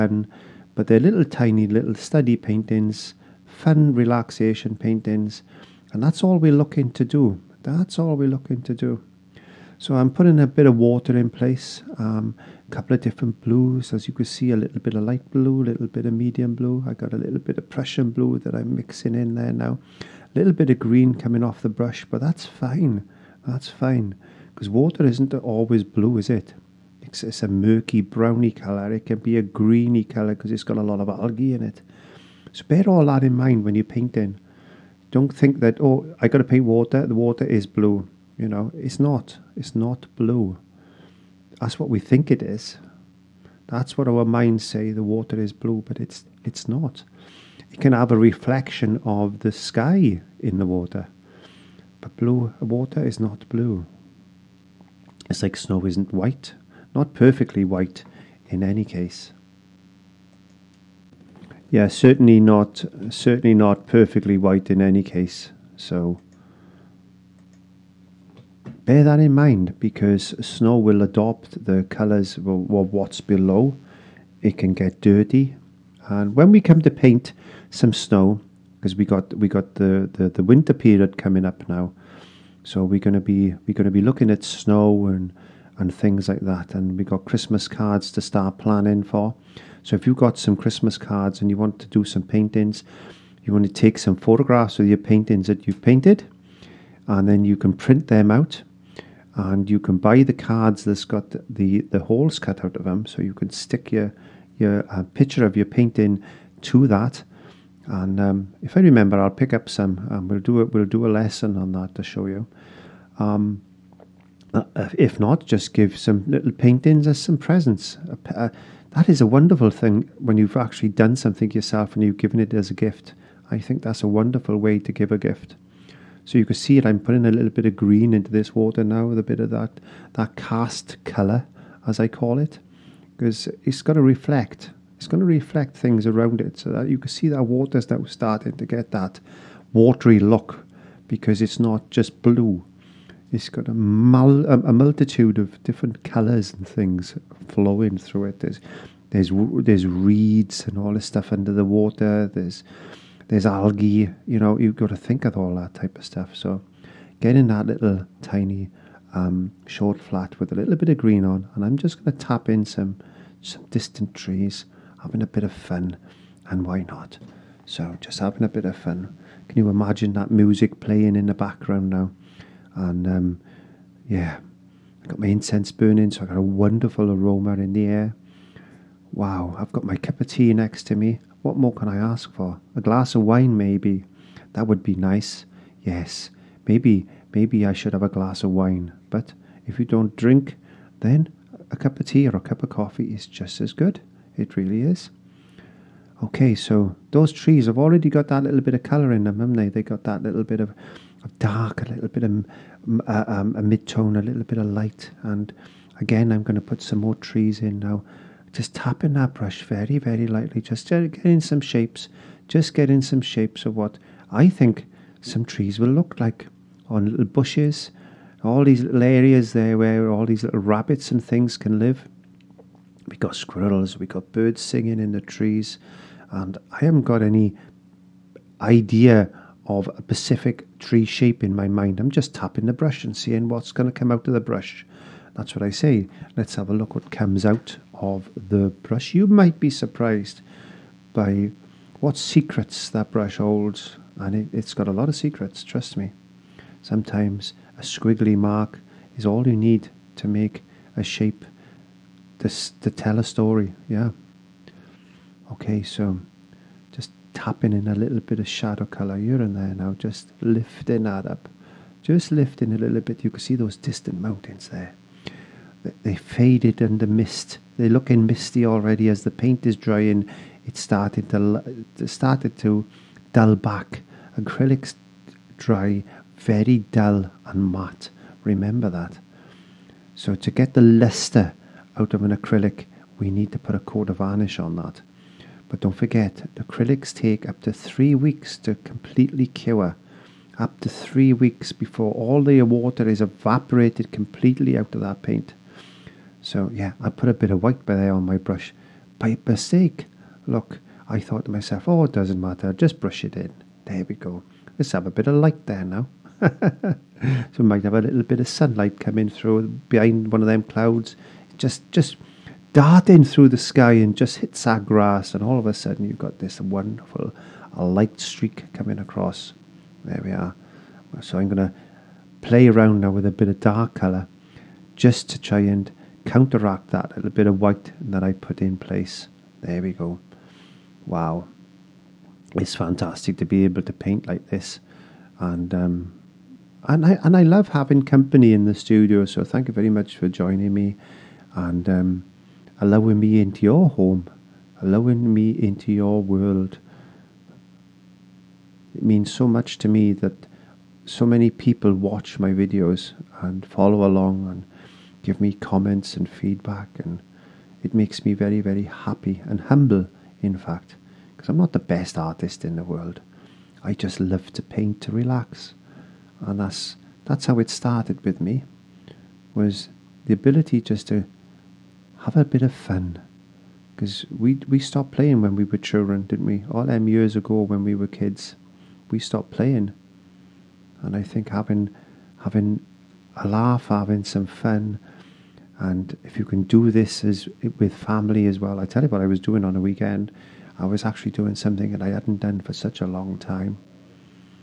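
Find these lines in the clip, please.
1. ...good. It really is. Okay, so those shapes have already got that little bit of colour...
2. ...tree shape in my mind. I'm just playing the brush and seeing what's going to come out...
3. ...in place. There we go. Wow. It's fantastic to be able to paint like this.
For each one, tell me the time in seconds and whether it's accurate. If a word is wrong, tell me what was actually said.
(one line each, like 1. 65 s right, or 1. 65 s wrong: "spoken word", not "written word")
1. 193 s wrong: "trees", not "shapes"
2. 230 s wrong: "tapping", not "playing"
3. 328 s right.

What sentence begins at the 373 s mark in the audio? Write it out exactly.
Because we, we stopped playing when we were children, didn't we?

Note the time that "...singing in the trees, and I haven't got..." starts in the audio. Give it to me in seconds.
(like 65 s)
224 s.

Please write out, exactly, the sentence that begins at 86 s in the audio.
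And we got Christmas cards to start planning for.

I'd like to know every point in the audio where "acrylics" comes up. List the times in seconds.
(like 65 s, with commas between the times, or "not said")
274 s, 282 s, 286 s.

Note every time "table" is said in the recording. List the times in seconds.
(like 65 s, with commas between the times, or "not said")
not said.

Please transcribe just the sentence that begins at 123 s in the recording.
I think that's a wonderful way to give a gift.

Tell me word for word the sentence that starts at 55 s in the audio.
It's like snow isn't white not perfectly white in any case.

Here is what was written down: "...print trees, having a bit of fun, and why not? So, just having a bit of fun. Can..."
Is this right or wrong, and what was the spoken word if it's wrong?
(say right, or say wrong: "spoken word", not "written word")
wrong: "distant", not "print".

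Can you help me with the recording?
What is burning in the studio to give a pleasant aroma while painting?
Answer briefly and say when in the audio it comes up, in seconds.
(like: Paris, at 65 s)
incense, at 175 s.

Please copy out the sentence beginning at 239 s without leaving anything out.
You might be surprised by what secrets that brush holds, and it, has got a lot of secrets, trust me.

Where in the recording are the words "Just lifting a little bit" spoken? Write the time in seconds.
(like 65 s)
262 s.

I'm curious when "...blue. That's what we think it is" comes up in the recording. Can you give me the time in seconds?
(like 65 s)
40 s.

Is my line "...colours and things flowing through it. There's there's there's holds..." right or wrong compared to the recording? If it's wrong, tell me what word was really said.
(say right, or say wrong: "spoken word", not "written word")
wrong: "reeds", not "holds".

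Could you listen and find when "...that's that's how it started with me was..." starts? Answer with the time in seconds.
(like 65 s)
366 s.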